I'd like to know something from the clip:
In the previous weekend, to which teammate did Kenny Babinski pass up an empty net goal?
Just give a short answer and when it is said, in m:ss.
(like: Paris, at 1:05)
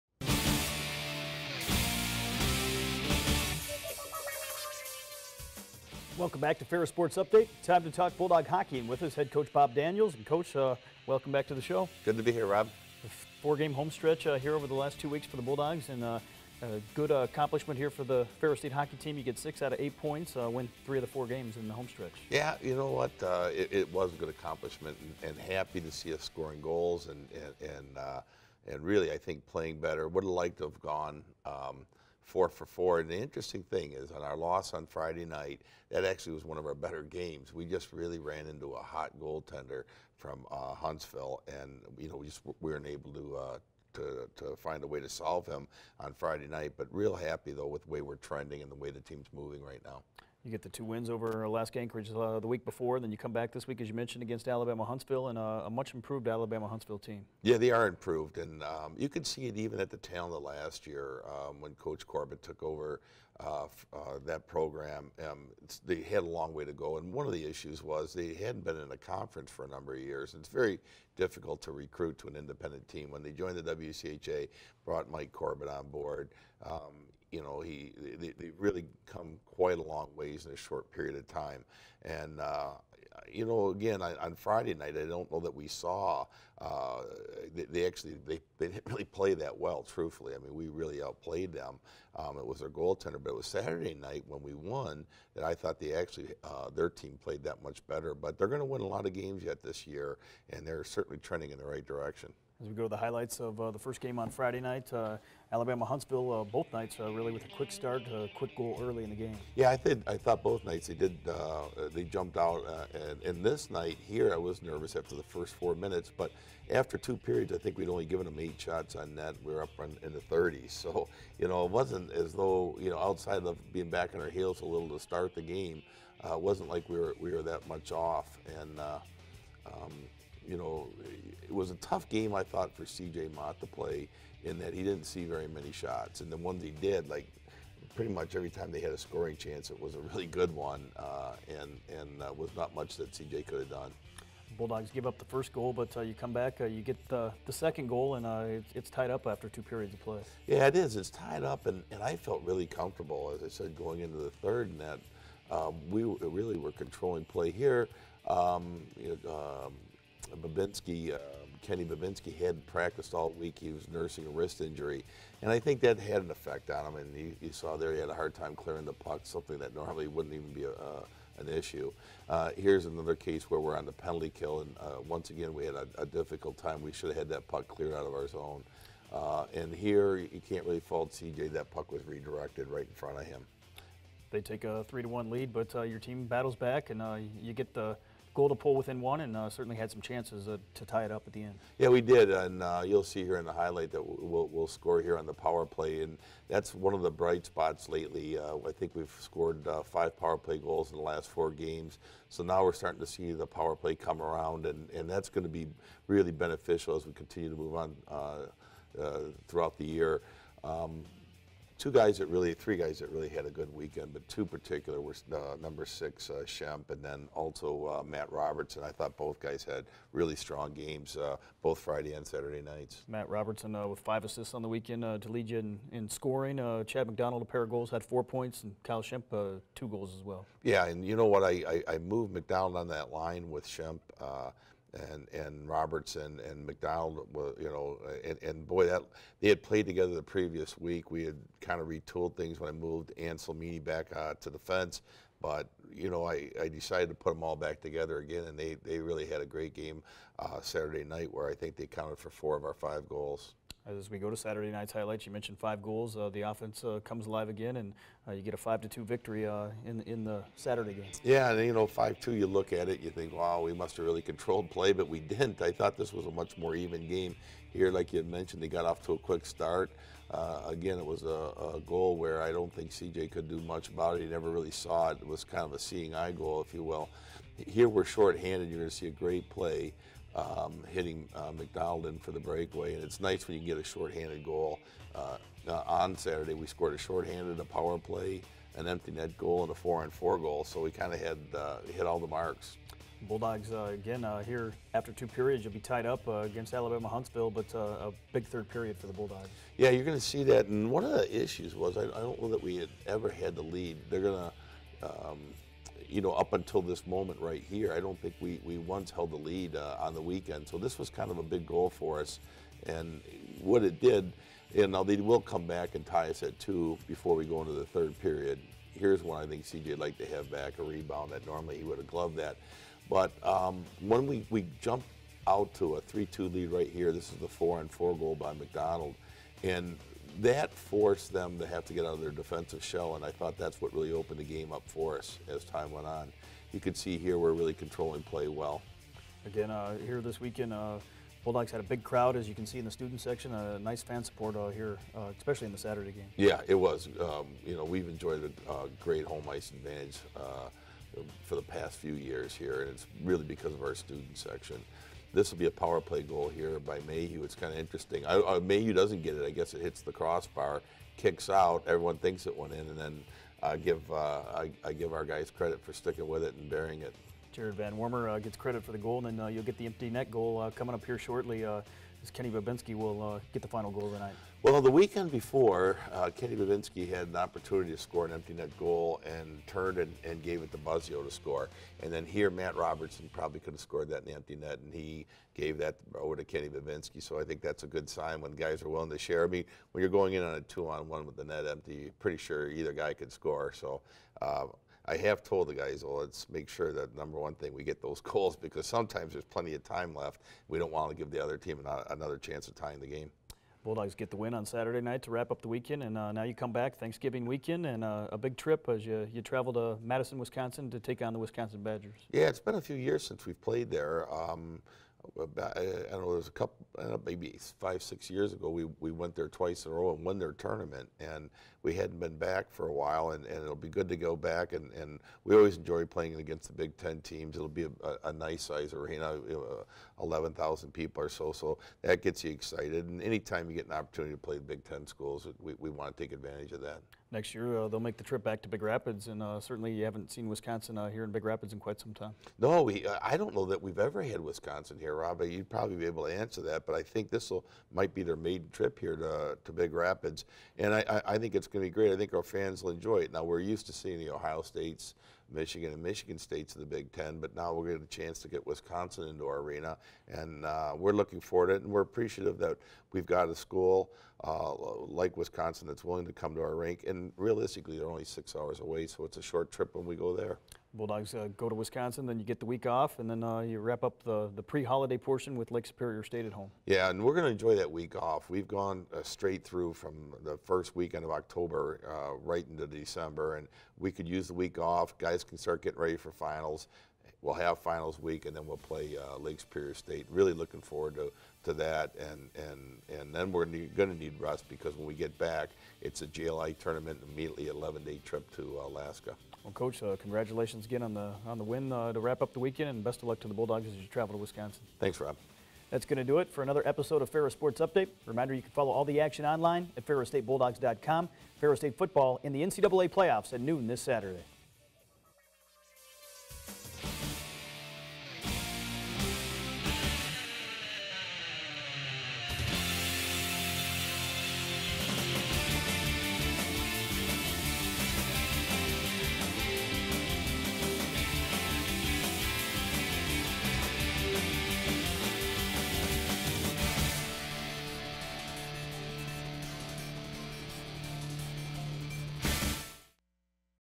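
Buzzio, at 6:20.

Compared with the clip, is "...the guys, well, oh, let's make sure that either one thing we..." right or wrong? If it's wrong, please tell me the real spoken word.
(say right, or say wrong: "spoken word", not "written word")
wrong: "number", not "either".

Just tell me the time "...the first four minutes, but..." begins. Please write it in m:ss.
1:55.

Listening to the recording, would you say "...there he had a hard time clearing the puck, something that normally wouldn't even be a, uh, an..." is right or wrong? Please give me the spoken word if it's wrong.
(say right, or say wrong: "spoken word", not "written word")
right.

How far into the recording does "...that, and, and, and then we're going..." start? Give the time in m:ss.
8:11.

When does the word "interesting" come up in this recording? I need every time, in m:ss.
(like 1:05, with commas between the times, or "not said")
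0:33, 5:57.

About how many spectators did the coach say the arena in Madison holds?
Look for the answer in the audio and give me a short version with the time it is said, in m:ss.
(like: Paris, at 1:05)
11,000, at 7:10.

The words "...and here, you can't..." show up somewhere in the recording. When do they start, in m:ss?
2:59.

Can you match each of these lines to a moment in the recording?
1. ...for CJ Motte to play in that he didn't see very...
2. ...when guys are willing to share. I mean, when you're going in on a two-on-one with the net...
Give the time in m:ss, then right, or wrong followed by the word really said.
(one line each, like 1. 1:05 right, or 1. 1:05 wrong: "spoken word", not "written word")
1. 2:12 right
2. 6:28 right.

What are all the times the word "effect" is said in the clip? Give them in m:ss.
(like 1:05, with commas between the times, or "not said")
2:46.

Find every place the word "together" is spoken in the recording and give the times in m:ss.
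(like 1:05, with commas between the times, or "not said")
3:59, 4:07.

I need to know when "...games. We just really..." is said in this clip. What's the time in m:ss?
0:37.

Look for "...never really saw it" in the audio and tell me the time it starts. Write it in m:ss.
4:34.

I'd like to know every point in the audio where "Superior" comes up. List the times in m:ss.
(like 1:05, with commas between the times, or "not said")
7:55, 8:09.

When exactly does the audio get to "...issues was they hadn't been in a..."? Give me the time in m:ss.
1:07.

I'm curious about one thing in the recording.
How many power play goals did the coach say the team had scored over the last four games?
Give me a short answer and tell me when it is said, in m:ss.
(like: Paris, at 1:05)
5, at 3:19.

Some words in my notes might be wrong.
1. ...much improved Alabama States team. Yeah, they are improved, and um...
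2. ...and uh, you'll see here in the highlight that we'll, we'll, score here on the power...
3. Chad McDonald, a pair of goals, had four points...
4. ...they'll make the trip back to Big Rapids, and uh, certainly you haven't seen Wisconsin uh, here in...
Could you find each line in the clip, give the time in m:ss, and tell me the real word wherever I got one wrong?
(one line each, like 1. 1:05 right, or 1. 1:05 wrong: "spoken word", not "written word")
1. 0:55 wrong: "Huntsville", not "States"
2. 3:12 right
3. 3:46 right
4. 7:17 right.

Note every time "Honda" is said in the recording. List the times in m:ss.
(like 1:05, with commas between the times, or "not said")
not said.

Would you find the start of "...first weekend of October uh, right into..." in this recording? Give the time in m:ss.
8:00.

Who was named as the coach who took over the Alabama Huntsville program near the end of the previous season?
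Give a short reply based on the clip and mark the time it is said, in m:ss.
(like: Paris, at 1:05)
Mike Corbett, at 1:15.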